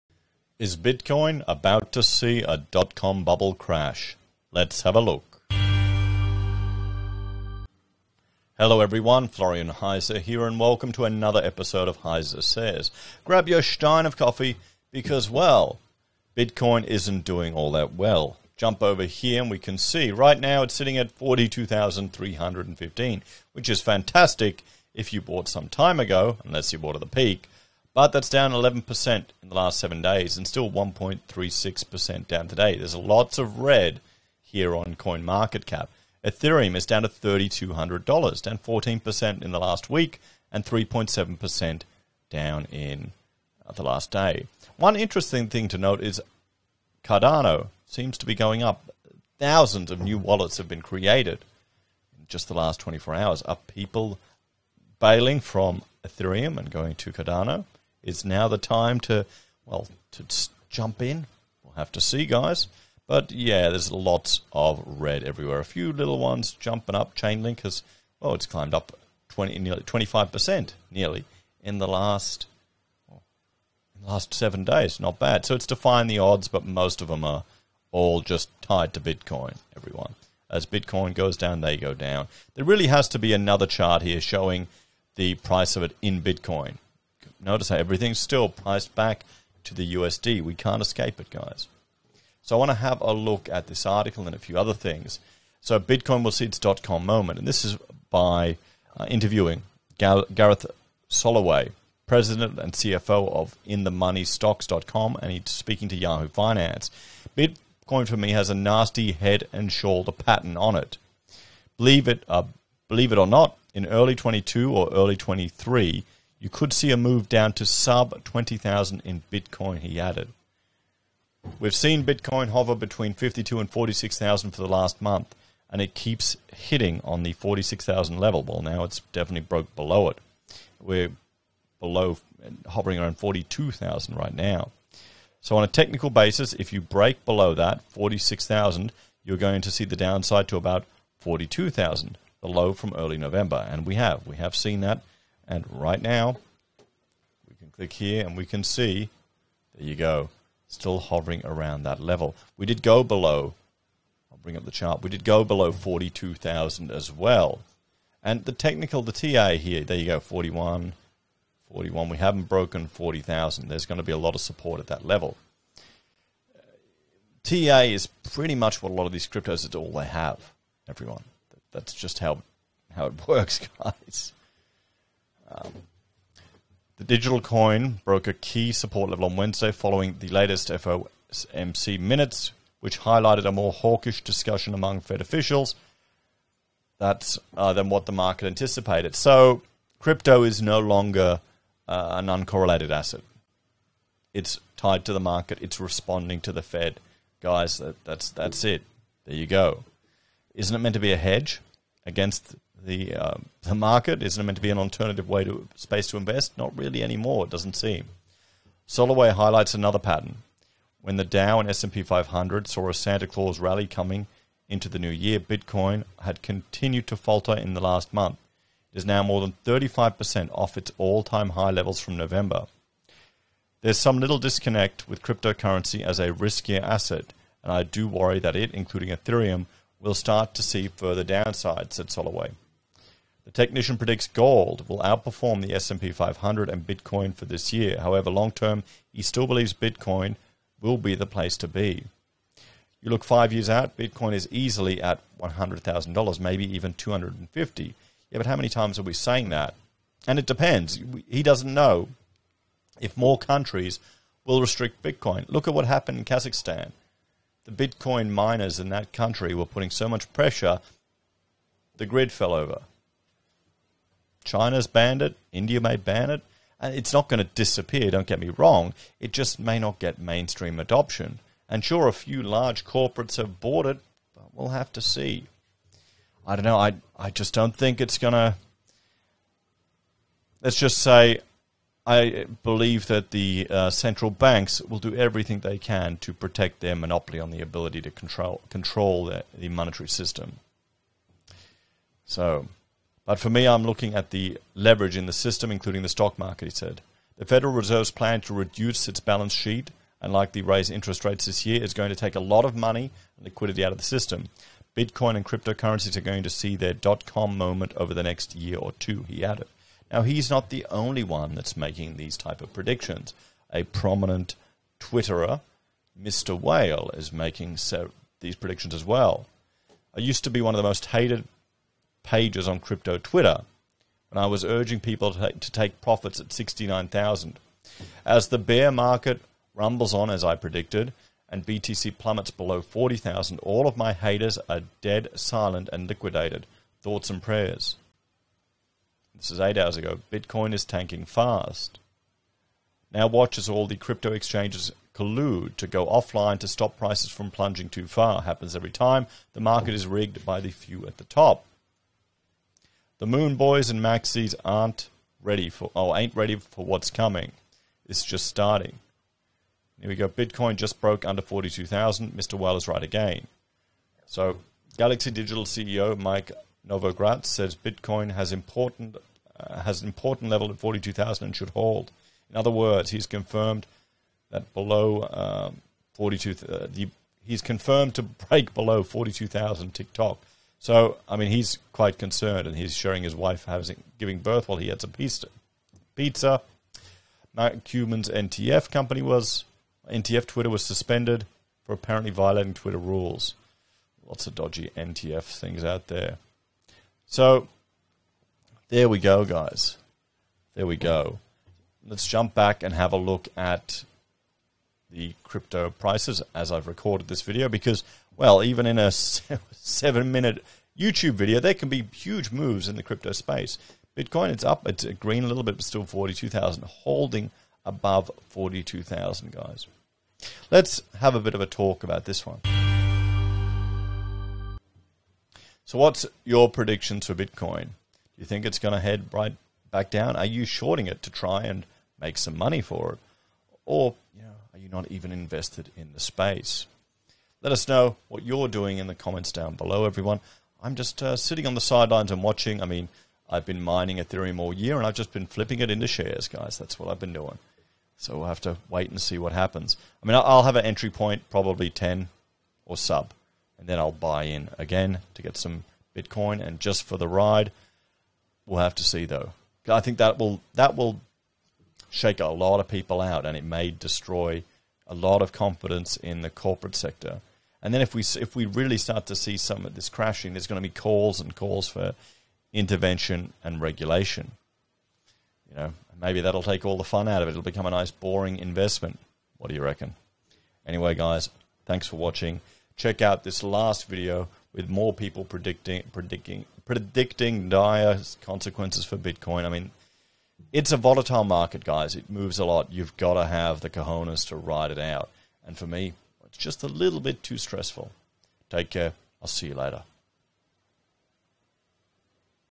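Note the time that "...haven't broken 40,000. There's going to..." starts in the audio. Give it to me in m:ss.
2:42.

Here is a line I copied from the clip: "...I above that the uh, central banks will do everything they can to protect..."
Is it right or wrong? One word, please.
wrong.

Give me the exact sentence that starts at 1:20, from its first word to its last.
As Bitcoin goes down, they go down.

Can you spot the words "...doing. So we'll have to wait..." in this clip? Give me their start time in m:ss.
7:27.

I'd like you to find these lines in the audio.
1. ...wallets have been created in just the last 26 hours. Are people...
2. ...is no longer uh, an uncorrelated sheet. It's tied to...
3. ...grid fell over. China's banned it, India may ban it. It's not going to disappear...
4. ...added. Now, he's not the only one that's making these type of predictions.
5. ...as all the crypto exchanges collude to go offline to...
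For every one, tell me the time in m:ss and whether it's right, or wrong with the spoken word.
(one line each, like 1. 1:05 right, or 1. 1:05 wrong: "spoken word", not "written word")
1. 0:50 wrong: "24", not "26"
2. 3:10 wrong: "asset", not "sheet"
3. 4:22 right
4. 5:09 right
5. 5:43 right.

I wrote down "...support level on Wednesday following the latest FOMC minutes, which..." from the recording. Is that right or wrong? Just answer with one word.
right.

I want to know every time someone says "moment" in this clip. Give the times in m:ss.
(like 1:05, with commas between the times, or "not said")
1:37, 5:07.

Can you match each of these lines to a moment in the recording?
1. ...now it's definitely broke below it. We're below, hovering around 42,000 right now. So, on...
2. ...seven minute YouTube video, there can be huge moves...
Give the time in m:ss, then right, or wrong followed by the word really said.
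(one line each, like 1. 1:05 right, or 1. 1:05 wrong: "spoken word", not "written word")
1. 2:08 right
2. 6:49 right.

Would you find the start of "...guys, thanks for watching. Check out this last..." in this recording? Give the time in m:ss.
8:01.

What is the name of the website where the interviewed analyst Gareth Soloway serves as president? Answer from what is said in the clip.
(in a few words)
InTheMoneyStocks.com.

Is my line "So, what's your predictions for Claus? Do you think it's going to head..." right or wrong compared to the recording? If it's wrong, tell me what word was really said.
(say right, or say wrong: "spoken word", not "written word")
wrong: "Bitcoin", not "Claus".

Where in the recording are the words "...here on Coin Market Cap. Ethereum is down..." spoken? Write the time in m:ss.
0:34.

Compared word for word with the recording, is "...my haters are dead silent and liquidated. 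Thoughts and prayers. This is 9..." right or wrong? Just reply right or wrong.
wrong.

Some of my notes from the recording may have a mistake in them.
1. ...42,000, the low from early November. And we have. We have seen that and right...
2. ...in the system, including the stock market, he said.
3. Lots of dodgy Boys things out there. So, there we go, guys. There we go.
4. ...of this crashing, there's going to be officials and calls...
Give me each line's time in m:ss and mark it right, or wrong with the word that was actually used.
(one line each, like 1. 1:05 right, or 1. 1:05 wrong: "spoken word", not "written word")
1. 2:21 right
2. 4:55 right
3. 6:34 wrong: "NTF", not "Boys"
4. 7:49 wrong: "calls", not "officials".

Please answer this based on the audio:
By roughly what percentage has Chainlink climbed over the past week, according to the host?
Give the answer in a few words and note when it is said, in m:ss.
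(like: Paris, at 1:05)
nearly 25%, at 1:09.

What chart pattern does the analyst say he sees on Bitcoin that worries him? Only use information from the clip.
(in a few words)
head and shoulder pattern.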